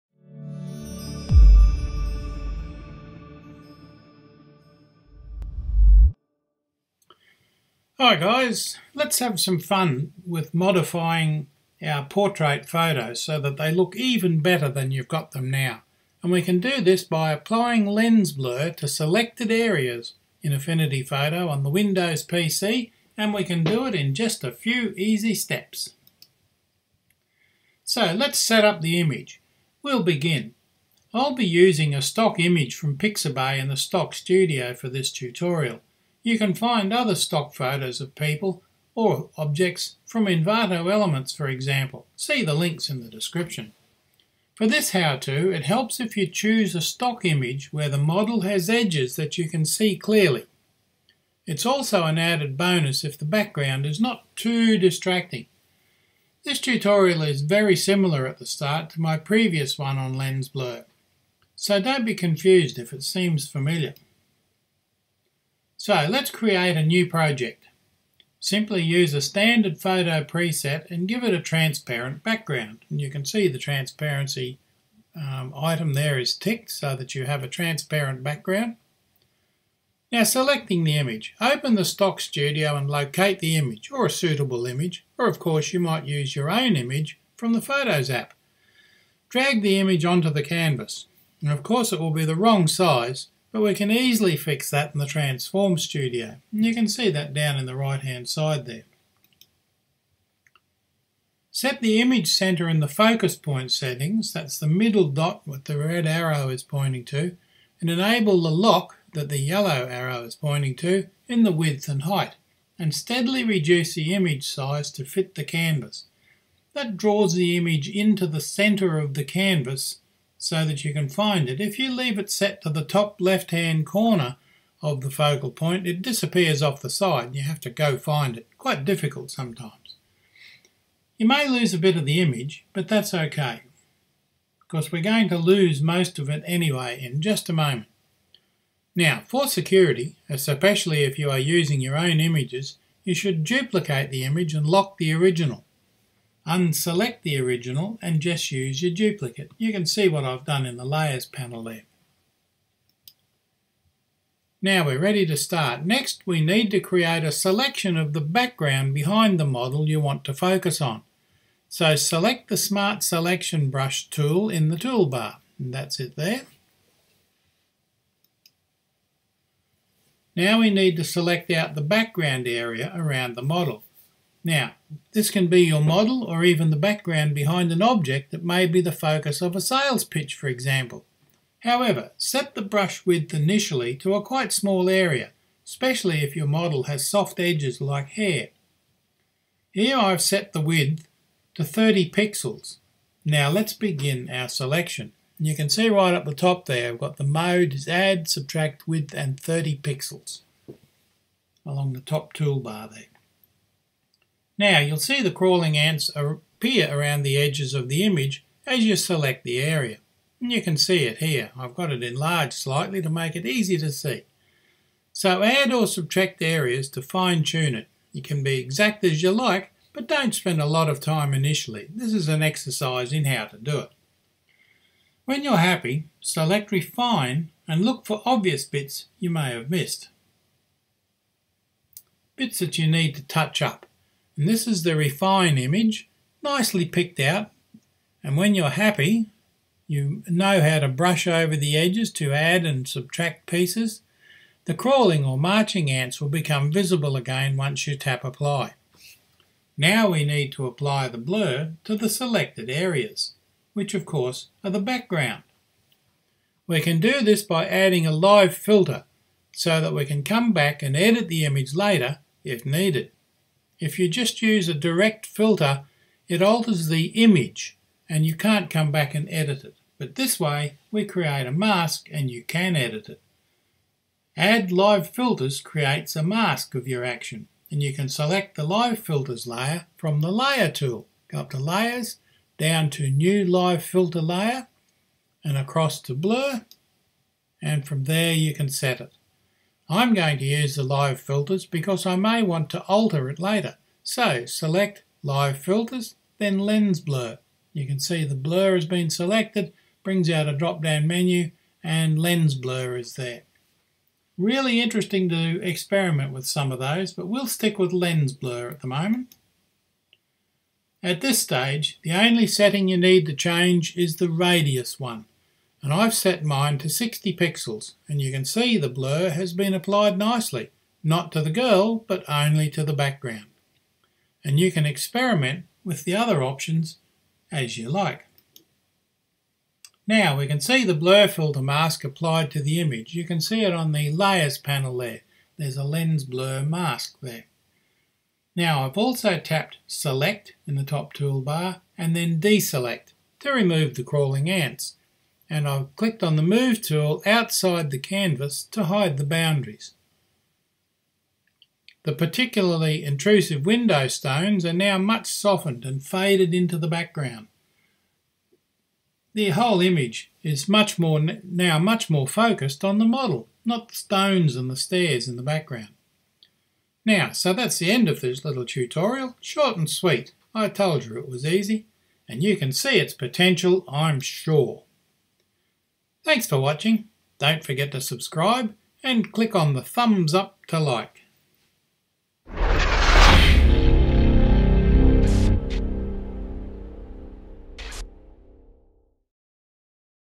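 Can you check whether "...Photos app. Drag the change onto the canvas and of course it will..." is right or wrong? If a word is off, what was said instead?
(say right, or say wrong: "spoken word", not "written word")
wrong: "image", not "change".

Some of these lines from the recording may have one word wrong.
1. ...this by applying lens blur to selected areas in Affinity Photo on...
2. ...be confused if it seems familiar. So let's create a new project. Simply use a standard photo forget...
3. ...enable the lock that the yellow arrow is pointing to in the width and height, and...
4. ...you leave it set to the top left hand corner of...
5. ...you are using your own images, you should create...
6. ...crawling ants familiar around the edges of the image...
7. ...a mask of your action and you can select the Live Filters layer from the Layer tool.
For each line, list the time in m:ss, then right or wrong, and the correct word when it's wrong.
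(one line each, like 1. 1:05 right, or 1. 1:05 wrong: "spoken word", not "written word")
1. 0:16 right
2. 1:02 wrong: "preset", not "forget"
3. 1:47 right
4. 2:01 right
5. 2:21 wrong: "duplicate", not "create"
6. 3:25 wrong: "appear", not "familiar"
7. 4:36 right.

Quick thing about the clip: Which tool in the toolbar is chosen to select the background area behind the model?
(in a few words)
Smart Selection Brush.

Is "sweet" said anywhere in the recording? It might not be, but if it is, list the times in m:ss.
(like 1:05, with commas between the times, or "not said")
6:09.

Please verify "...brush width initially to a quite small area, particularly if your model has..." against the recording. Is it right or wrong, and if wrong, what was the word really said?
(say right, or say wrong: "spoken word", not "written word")
wrong: "especially", not "particularly".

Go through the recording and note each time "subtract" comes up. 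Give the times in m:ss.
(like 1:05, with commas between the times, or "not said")
3:18, 3:35, 4:02.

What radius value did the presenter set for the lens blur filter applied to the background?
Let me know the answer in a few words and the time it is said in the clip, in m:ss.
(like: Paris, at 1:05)
60 pixels, at 5:16.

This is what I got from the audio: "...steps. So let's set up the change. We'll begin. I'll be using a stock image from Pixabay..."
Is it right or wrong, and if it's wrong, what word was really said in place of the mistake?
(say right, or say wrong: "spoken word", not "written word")
wrong: "image", not "change".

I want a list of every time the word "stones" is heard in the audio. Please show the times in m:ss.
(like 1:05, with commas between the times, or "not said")
5:54, 6:03.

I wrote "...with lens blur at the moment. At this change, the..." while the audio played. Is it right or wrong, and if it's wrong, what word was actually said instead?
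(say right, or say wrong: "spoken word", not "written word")
wrong: "stage", not "change".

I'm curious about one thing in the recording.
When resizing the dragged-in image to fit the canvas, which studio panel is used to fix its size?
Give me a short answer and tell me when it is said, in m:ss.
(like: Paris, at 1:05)
Transform Studio, at 1:35.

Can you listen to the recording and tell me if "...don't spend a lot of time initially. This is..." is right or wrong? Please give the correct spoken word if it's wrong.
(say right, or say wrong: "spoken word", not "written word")
right.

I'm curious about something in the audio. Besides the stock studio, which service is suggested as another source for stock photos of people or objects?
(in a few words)
Envato Elements.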